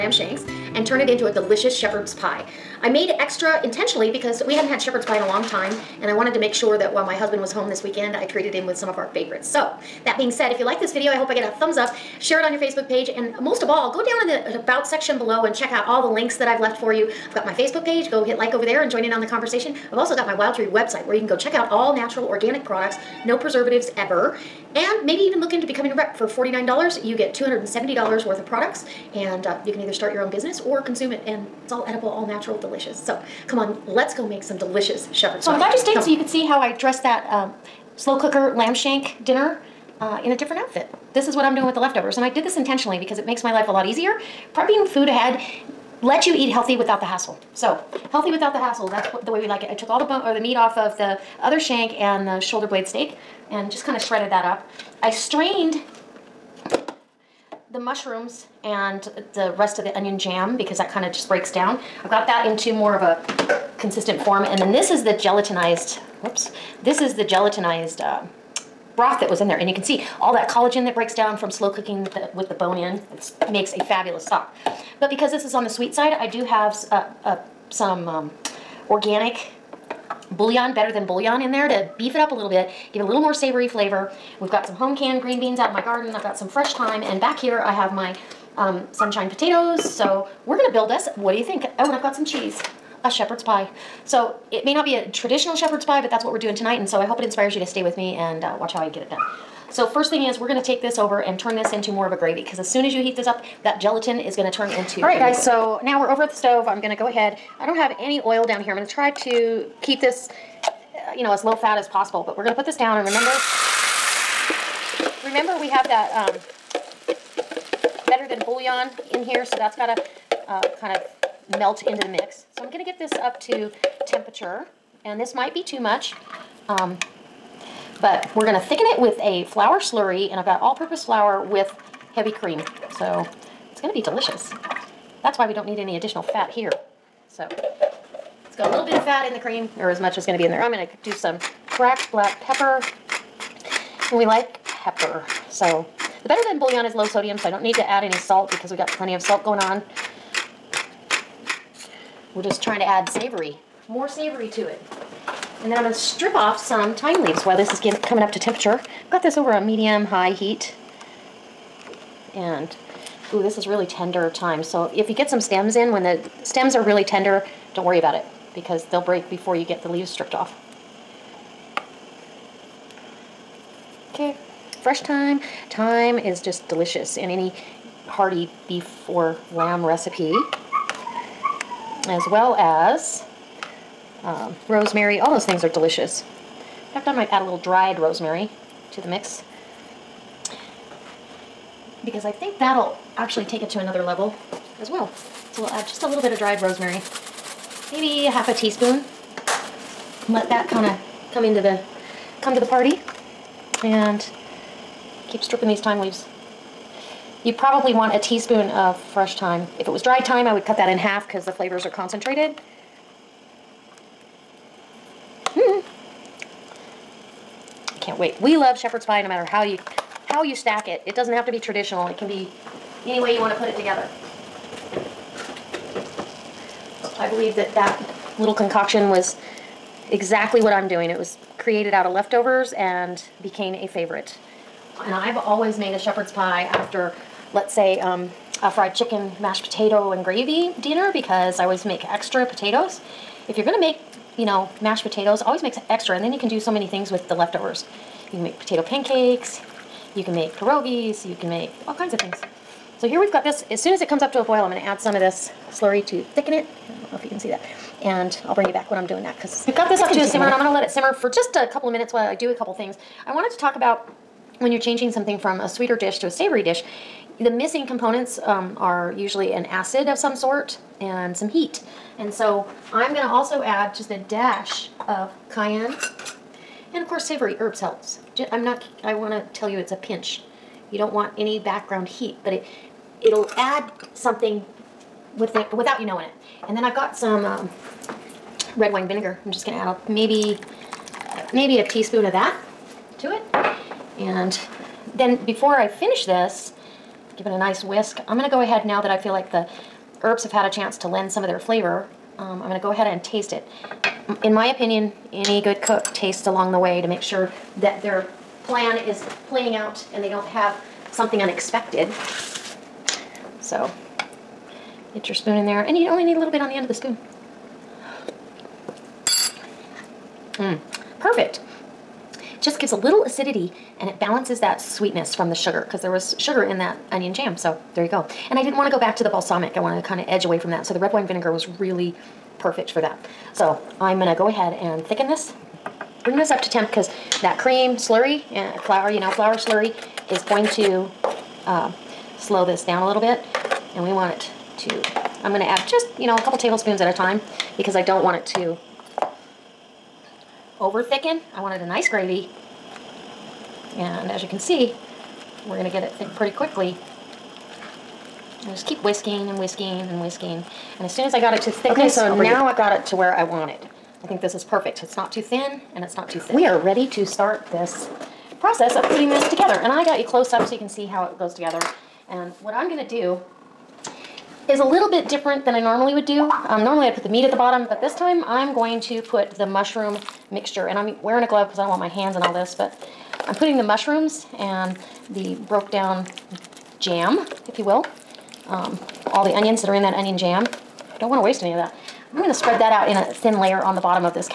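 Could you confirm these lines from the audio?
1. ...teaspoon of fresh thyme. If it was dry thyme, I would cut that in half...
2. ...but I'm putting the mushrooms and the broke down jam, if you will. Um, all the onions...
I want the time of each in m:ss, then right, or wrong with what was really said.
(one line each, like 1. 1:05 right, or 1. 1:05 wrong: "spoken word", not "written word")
1. 3:28 right
2. 6:22 right.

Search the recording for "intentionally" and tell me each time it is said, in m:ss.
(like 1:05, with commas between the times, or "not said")
0:03, 0:42.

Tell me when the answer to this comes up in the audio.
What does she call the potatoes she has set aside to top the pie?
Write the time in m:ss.
1:28.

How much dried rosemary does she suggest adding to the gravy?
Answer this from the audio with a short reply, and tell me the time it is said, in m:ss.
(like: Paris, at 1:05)
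half a teaspoon, at 3:18.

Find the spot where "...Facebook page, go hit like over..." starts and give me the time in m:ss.
0:17.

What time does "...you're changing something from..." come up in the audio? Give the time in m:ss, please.
4:24.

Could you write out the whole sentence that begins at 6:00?
And as soon as I got it to thickness, okay, so now I've got it to where I want it.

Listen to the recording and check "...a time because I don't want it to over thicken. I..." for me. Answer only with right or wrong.
right.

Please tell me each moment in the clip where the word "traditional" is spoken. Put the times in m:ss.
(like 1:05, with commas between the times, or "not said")
1:35, 3:41.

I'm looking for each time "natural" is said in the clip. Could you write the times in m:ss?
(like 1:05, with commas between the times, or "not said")
0:21, 0:32.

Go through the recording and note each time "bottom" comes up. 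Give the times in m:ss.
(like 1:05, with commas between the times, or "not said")
6:17, 6:33.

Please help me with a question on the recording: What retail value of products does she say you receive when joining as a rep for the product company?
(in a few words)
$270.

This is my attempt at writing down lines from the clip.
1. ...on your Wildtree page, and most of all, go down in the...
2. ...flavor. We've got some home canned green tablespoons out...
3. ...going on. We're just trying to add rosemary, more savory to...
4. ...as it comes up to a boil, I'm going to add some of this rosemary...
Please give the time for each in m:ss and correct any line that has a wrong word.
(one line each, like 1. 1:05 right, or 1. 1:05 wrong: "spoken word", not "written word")
1. 0:12 wrong: "Facebook", not "Wildtree"
2. 1:23 wrong: "beans", not "tablespoons"
3. 2:29 wrong: "savory", not "rosemary"
4. 4:13 wrong: "slurry", not "rosemary".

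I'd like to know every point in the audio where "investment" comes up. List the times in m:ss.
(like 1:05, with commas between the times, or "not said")
not said.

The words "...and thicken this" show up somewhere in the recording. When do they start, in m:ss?
5:34.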